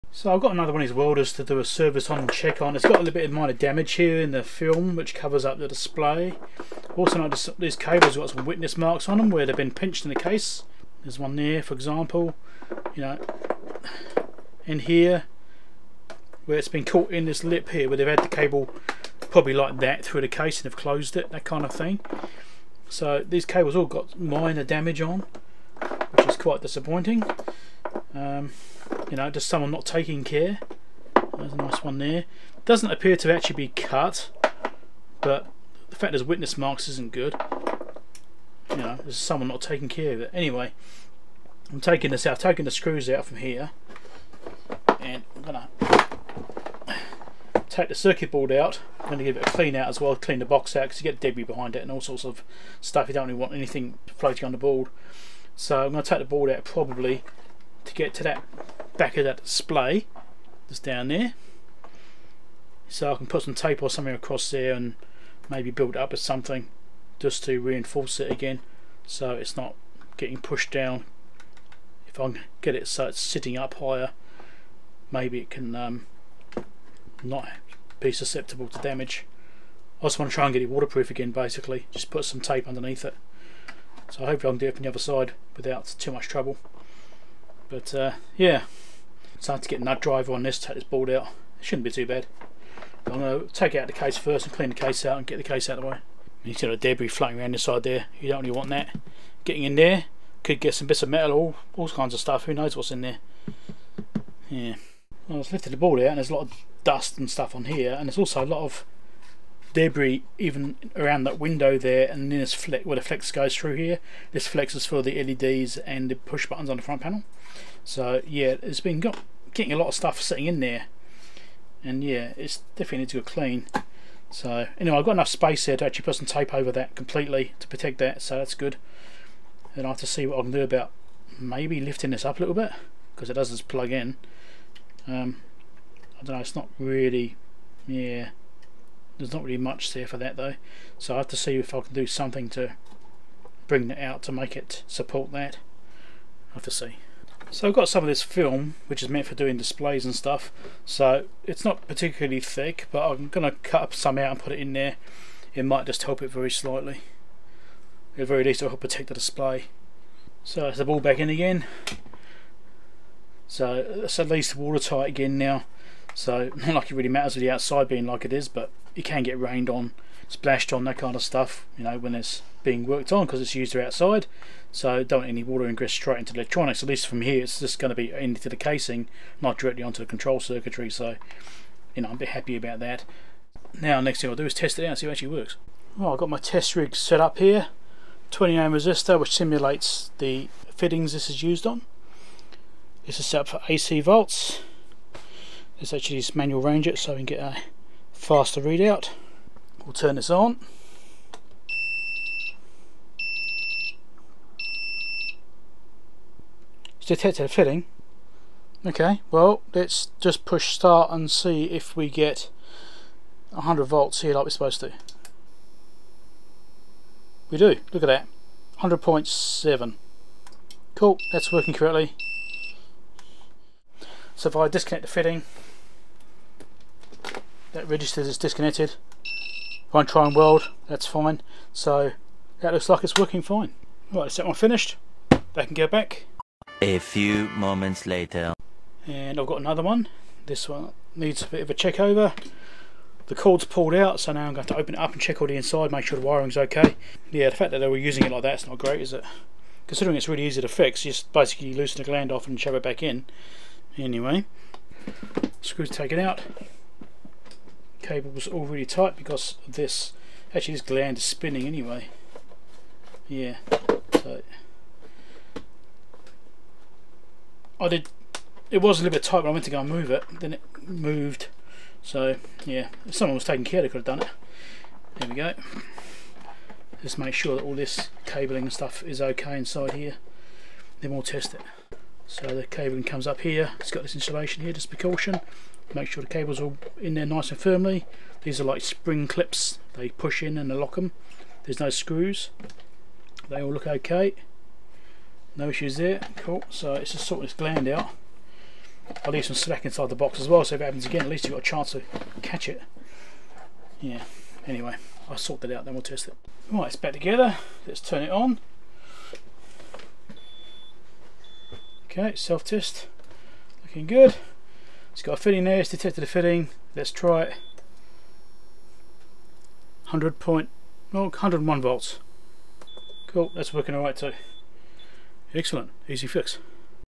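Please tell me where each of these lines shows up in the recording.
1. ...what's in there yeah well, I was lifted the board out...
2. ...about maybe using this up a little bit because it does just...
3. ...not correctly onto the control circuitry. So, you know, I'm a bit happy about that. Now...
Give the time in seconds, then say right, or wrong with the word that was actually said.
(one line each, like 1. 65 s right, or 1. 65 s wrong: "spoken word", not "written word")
1. 102 s right
2. 130 s wrong: "lifting", not "using"
3. 179 s wrong: "directly", not "correctly".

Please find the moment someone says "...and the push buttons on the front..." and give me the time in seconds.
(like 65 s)
115 s.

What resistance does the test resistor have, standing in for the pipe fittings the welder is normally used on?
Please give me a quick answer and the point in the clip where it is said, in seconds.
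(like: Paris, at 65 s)
20 ohm, at 188 s.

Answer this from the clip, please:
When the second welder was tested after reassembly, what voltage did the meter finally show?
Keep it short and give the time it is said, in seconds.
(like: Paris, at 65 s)
101 volts, at 321 s.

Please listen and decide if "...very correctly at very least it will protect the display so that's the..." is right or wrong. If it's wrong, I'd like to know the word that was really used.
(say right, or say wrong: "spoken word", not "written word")
wrong: "slightly", not "correctly".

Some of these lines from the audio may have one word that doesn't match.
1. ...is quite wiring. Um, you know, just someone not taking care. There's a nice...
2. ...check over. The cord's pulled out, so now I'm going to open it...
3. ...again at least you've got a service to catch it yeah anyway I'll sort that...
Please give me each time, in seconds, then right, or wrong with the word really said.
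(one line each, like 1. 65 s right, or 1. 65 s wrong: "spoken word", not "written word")
1. 26 s wrong: "disappointing", not "wiring"
2. 241 s right
3. 301 s wrong: "chance", not "service".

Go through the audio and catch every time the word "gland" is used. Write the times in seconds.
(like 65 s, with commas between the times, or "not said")
252 s, 260 s, 297 s.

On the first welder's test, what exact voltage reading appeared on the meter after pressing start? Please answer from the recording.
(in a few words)
100.7.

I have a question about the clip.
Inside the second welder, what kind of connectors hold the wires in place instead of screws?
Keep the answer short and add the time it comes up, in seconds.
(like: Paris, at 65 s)
spring clips, at 288 s.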